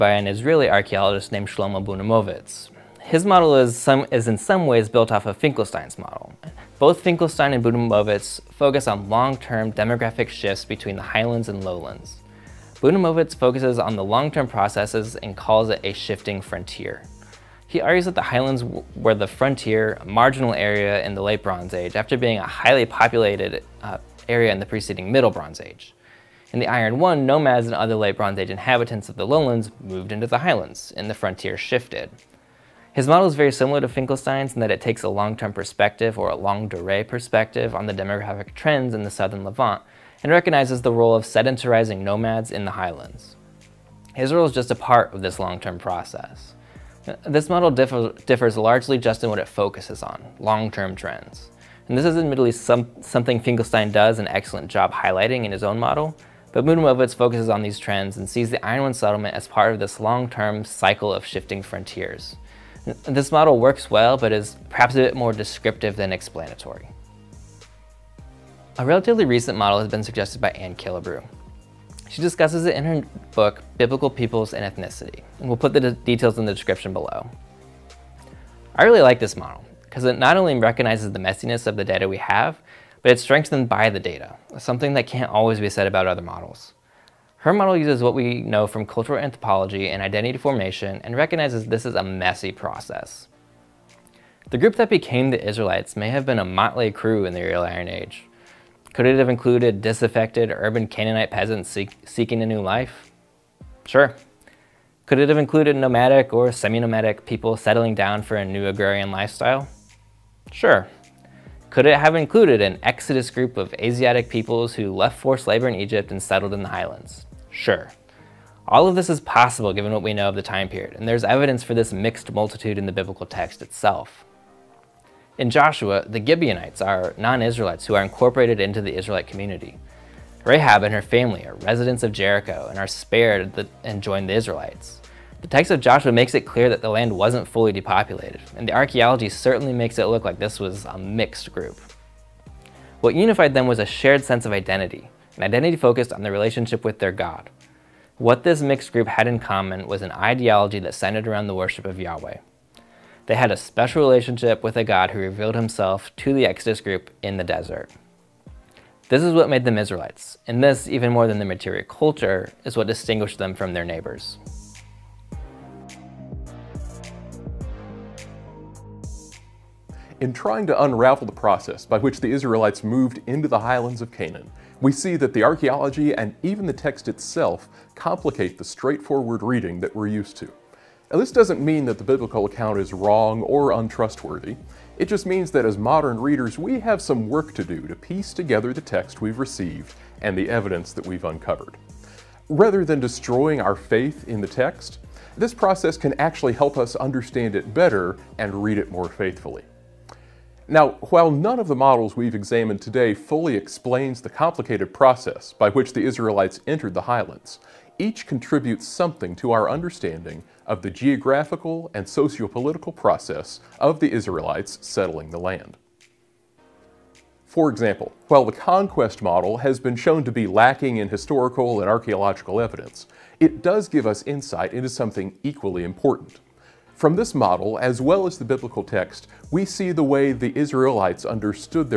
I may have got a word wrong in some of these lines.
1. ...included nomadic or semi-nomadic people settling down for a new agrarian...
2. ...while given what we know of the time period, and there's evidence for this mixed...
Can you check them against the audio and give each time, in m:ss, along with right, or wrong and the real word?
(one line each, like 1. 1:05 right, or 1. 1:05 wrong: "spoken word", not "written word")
1. 1:45 right
2. 1:59 wrong: "possible", not "while".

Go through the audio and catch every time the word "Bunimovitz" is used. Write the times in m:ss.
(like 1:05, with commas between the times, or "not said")
0:01, 0:07, 0:12, 0:56.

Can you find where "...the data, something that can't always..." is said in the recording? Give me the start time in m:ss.
1:23.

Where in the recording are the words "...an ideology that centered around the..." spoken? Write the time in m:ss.
2:30.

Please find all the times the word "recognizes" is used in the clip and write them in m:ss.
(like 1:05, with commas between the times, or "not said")
0:40, 1:20, 1:31.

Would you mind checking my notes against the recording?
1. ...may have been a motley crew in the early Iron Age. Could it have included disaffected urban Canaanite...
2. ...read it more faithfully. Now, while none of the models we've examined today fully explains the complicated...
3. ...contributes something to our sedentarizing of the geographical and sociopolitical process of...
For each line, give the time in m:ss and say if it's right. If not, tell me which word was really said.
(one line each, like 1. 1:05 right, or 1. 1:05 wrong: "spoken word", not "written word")
1. 1:35 right
2. 3:18 right
3. 3:28 wrong: "understanding", not "sedentarizing".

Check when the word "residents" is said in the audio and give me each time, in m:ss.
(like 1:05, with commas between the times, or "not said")
2:11.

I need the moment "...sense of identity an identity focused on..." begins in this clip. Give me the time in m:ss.
2:24.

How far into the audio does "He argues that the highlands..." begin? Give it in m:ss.
0:17.